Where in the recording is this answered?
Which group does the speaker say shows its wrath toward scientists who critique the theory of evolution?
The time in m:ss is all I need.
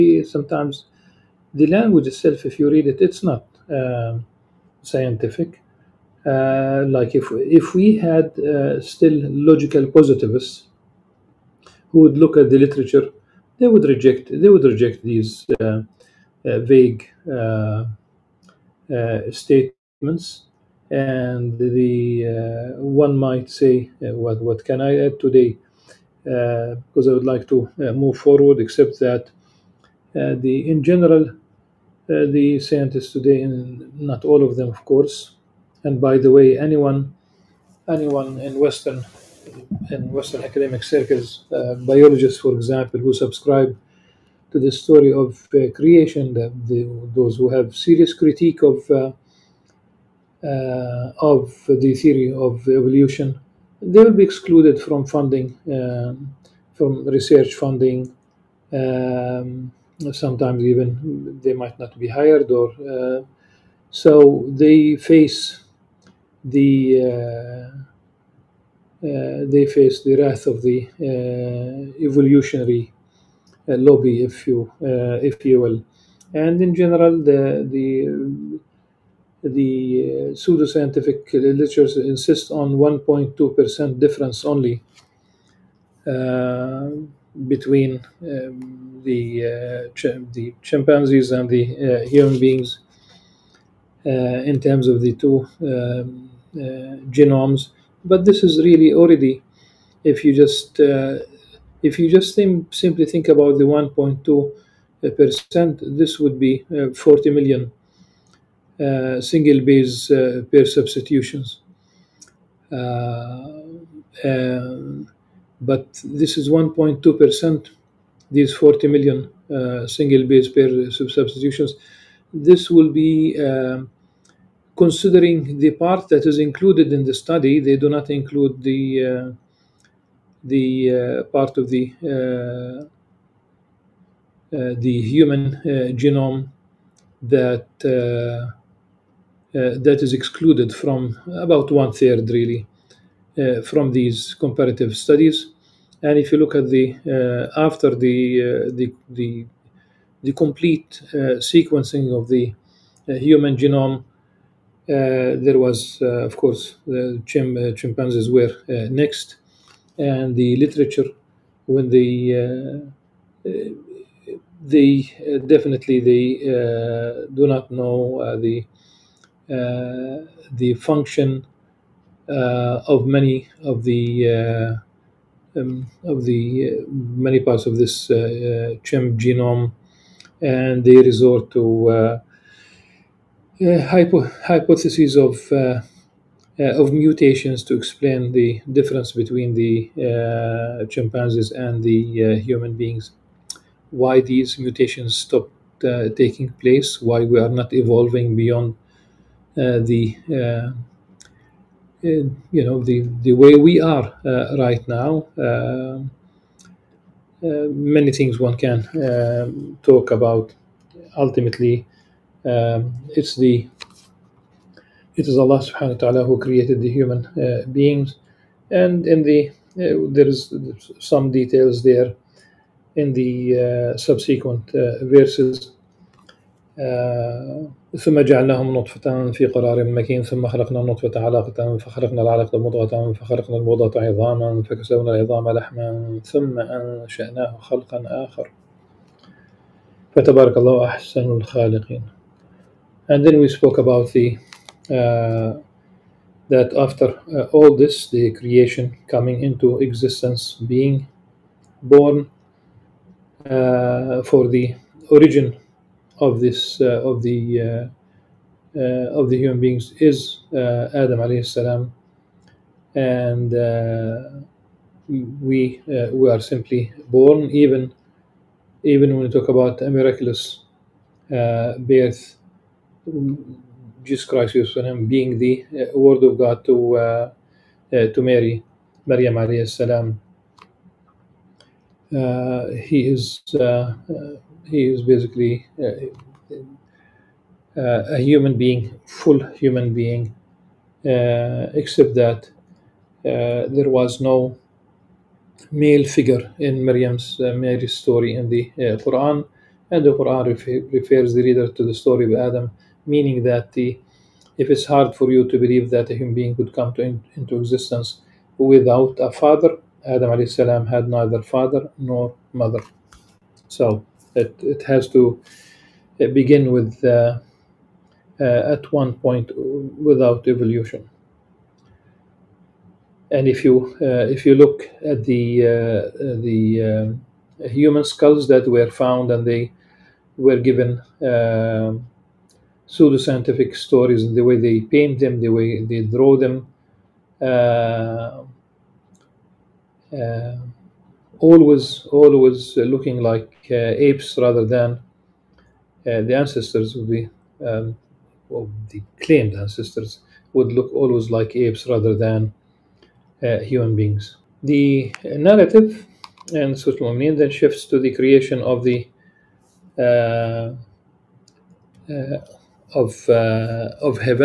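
1:12.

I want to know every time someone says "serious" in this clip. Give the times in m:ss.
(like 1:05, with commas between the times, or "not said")
0:47.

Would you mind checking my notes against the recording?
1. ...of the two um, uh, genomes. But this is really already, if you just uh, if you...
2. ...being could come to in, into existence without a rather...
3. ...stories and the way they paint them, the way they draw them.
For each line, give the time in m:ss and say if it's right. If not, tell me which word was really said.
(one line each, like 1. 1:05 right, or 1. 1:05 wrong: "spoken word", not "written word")
1. 1:34 right
2. 5:06 wrong: "father", not "rather"
3. 5:33 right.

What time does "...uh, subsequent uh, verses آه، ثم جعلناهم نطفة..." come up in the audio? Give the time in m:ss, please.
3:43.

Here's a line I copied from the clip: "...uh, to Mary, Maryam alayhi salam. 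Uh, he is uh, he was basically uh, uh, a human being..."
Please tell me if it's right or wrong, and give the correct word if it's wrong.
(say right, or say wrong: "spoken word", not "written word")
right.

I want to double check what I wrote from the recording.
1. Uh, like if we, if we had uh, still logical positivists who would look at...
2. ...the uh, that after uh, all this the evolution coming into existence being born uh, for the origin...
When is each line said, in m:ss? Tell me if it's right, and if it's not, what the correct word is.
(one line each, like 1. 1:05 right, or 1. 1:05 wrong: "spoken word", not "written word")
1. 0:06 right
2. 4:04 wrong: "creation", not "evolution".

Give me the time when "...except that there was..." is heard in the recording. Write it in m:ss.
4:51.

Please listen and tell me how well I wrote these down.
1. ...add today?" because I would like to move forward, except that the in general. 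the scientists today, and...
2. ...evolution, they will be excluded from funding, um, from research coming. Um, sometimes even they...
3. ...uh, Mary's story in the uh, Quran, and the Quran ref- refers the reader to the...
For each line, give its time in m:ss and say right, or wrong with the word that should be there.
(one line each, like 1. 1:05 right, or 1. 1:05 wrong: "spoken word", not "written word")
1. 0:25 right
2. 0:52 wrong: "funding", not "coming"
3. 4:57 right.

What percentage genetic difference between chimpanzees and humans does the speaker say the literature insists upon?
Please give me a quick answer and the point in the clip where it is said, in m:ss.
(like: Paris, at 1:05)
1.2%, at 1:22.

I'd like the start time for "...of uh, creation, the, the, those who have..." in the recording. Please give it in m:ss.
0:45.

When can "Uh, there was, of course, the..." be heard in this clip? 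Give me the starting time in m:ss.
2:34.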